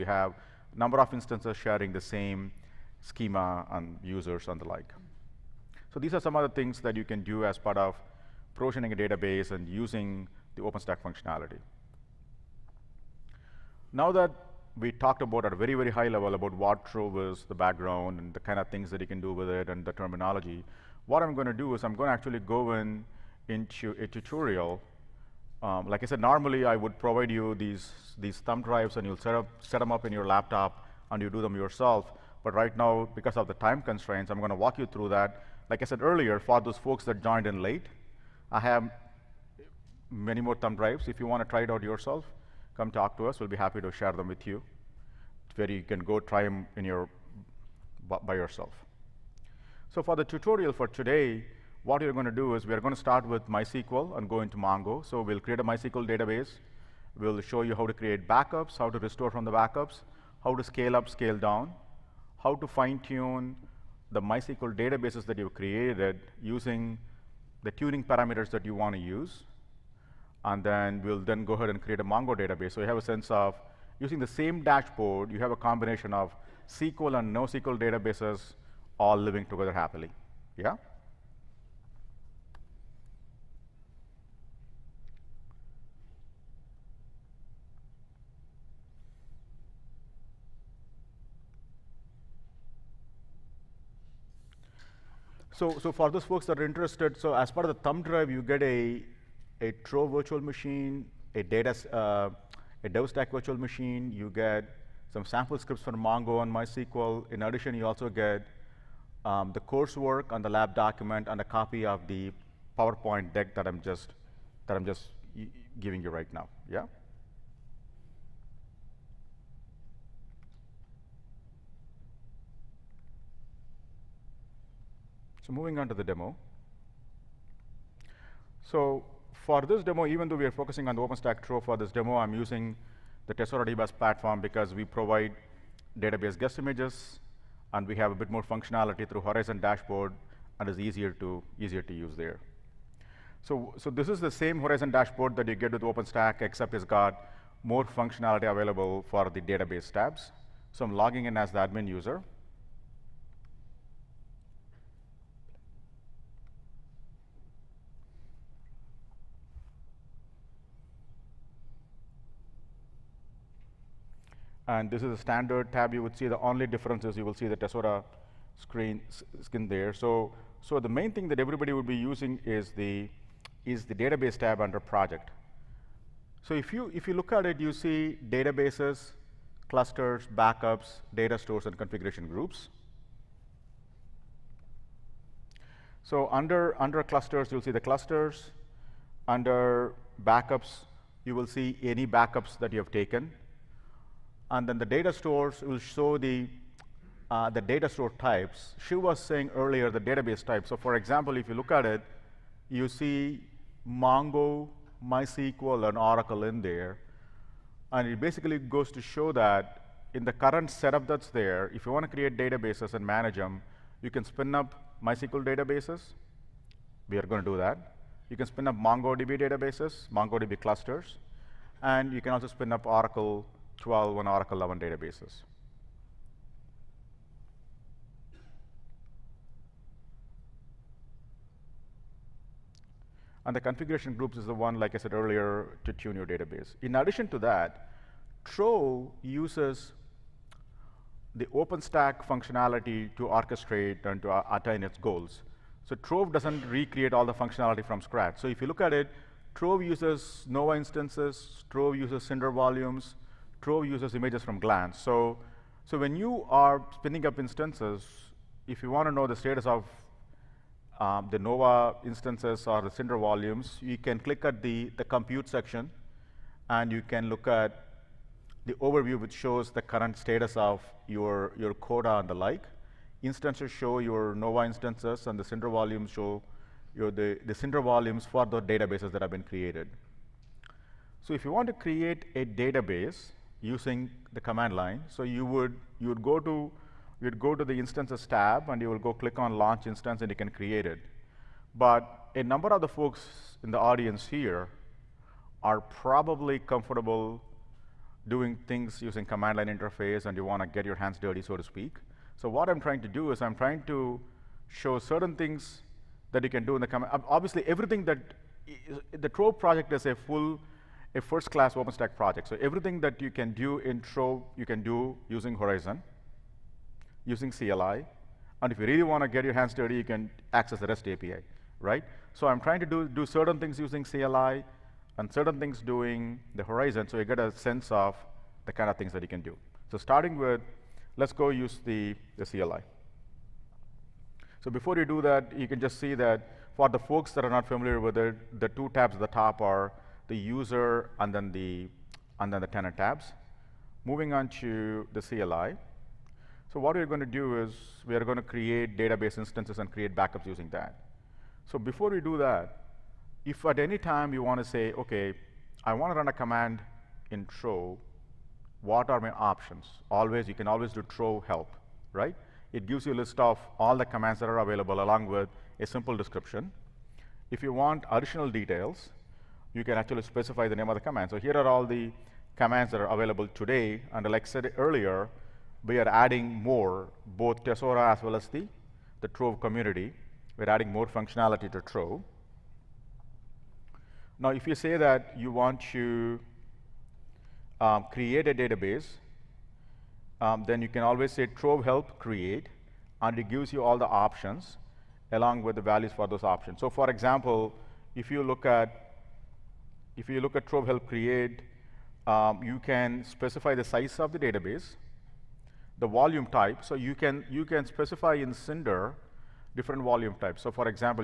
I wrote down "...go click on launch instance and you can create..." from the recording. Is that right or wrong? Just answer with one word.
right.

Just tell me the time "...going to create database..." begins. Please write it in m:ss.
5:48.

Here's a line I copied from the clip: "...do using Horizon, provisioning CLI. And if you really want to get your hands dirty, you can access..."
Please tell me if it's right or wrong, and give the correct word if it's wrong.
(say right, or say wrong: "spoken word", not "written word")
wrong: "using", not "provisioning".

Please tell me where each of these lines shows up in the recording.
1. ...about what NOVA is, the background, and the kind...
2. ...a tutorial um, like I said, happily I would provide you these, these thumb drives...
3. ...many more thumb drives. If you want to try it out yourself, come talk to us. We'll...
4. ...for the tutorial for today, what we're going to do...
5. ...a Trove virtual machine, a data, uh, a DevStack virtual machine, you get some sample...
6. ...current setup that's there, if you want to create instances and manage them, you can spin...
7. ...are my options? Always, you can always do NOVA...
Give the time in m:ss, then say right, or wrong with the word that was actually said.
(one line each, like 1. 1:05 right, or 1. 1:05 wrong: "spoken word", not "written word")
1. 0:16 wrong: "Trove", not "NOVA"
2. 0:23 wrong: "normally", not "happily"
3. 0:40 right
4. 0:50 right
5. 1:39 right
6. 3:30 wrong: "databases", not "instances"
7. 5:59 wrong: "Trove", not "NOVA".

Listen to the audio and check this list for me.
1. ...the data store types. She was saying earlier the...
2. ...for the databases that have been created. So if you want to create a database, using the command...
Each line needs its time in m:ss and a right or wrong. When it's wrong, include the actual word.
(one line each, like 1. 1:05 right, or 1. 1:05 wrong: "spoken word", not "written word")
1. 3:17 right
2. 4:38 right.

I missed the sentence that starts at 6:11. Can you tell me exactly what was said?
So here are all the commands that are available today.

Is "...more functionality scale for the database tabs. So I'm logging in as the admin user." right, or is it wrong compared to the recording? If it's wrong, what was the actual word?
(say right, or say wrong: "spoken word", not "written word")
wrong: "available", not "scale".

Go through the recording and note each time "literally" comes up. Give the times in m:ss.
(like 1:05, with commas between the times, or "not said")
not said.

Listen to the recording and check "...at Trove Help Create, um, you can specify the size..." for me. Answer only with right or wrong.
right.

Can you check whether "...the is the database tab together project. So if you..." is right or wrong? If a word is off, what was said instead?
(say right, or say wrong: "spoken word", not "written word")
wrong: "under", not "together".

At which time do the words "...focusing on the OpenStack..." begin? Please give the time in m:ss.
2:10.